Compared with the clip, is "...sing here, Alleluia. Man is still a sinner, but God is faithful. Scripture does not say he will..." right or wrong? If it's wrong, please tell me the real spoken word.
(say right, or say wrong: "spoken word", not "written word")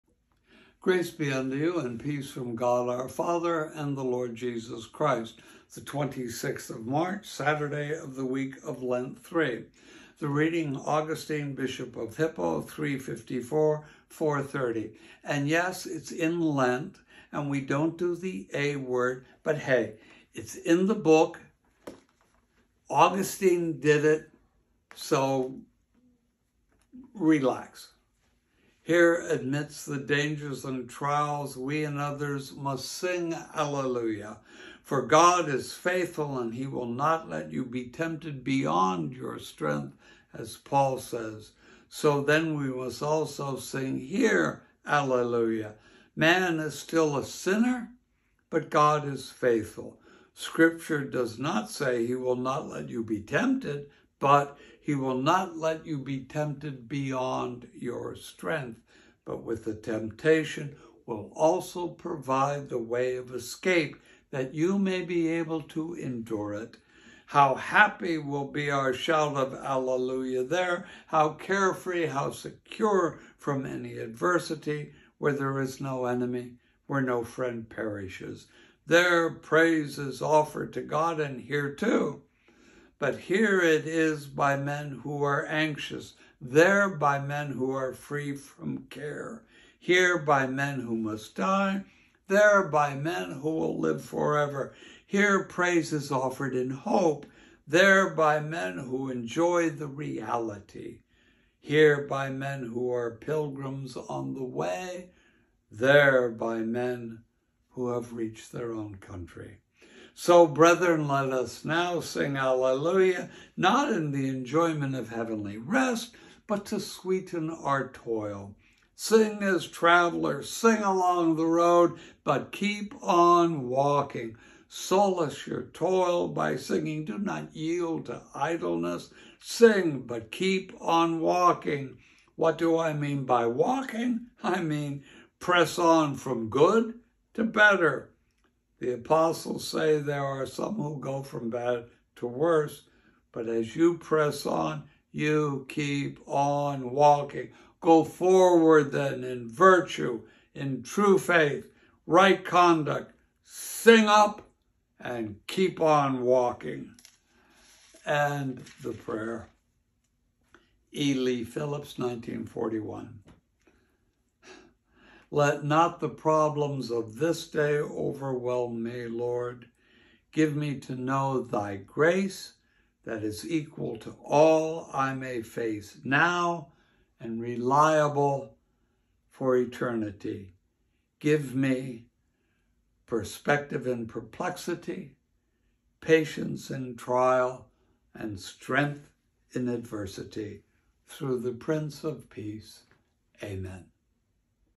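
right.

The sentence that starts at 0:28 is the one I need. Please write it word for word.
Here, amidst the dangers and trials, we and others must sing Alleluia.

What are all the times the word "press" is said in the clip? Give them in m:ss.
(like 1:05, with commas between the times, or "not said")
2:15, 2:23.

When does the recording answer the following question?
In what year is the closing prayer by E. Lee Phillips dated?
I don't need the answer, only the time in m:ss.
2:41.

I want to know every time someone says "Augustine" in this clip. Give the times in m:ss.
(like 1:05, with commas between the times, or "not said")
0:10, 0:22.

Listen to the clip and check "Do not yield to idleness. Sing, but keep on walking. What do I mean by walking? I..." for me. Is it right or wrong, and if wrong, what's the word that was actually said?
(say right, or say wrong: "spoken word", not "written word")
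right.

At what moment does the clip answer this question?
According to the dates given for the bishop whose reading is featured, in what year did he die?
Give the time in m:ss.
0:14.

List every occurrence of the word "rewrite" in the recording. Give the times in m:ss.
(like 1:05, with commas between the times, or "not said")
not said.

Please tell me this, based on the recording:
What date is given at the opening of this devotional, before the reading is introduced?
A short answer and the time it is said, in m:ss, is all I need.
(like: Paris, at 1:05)
26th of March, at 0:05.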